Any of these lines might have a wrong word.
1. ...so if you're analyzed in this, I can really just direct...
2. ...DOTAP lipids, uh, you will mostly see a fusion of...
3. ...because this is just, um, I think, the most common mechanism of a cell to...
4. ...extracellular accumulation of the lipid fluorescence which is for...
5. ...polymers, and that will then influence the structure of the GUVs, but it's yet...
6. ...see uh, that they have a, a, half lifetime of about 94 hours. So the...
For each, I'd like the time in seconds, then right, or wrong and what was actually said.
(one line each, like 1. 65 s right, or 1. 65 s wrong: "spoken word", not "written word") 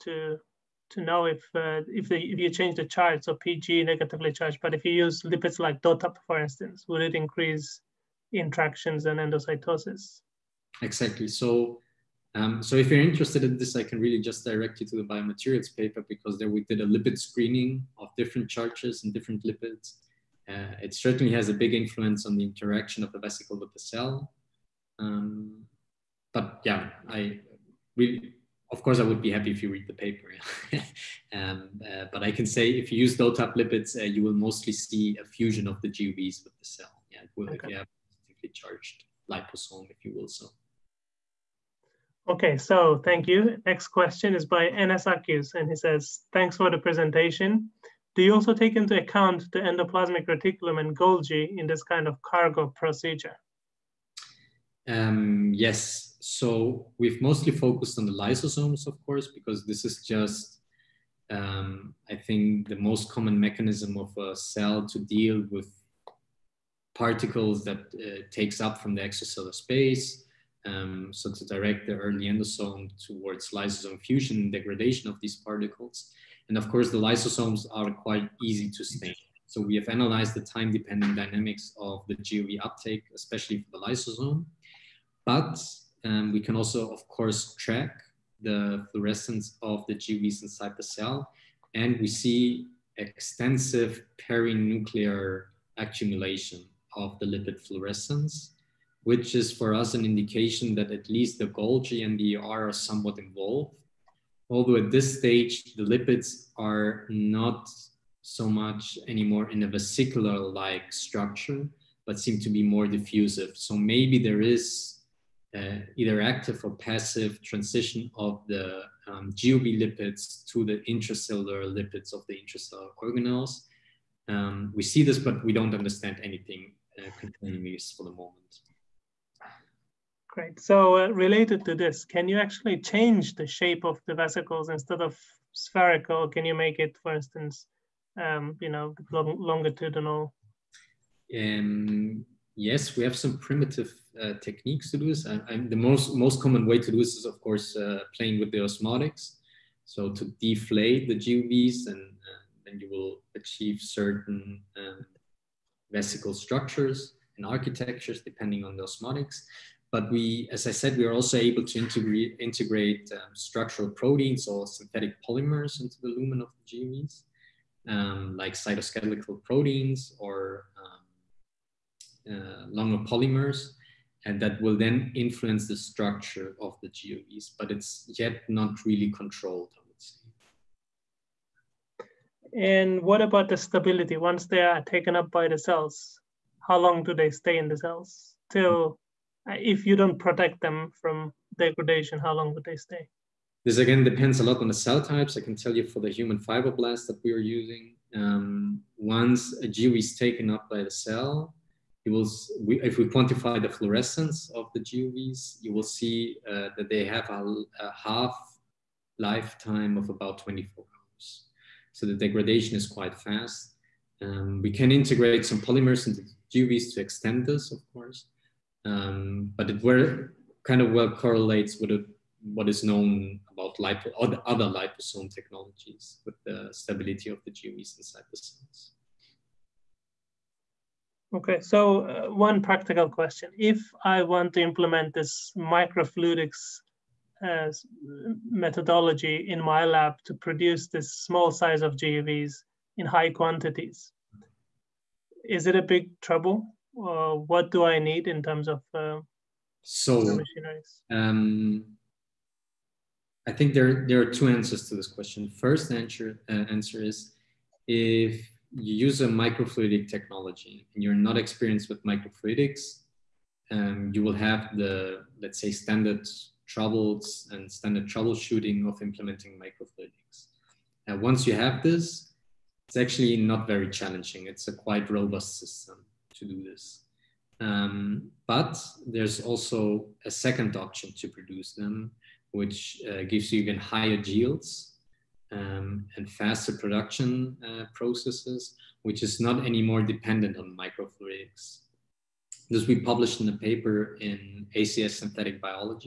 1. 12 s wrong: "interested", not "analyzed"
2. 33 s right
3. 59 s right
4. 94 s wrong: "perinuclear", not "extracellular"
5. 173 s right
6. 205 s wrong: "24", not "94".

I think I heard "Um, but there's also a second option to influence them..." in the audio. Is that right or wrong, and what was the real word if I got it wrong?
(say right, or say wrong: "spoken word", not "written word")
wrong: "produce", not "influence".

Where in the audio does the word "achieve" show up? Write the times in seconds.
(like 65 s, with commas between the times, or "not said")
153 s.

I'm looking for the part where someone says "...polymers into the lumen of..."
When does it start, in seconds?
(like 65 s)
165 s.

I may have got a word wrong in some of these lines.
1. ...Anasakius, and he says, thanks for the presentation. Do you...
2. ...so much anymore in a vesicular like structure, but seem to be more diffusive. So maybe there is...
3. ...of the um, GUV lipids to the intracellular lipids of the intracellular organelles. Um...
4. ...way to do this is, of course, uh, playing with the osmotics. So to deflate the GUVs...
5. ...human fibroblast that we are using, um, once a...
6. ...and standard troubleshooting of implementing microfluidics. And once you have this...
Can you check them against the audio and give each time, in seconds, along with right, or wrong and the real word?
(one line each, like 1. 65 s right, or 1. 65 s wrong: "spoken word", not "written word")
1. 44 s right
2. 108 s right
3. 118 s right
4. 146 s right
5. 196 s right
6. 267 s right.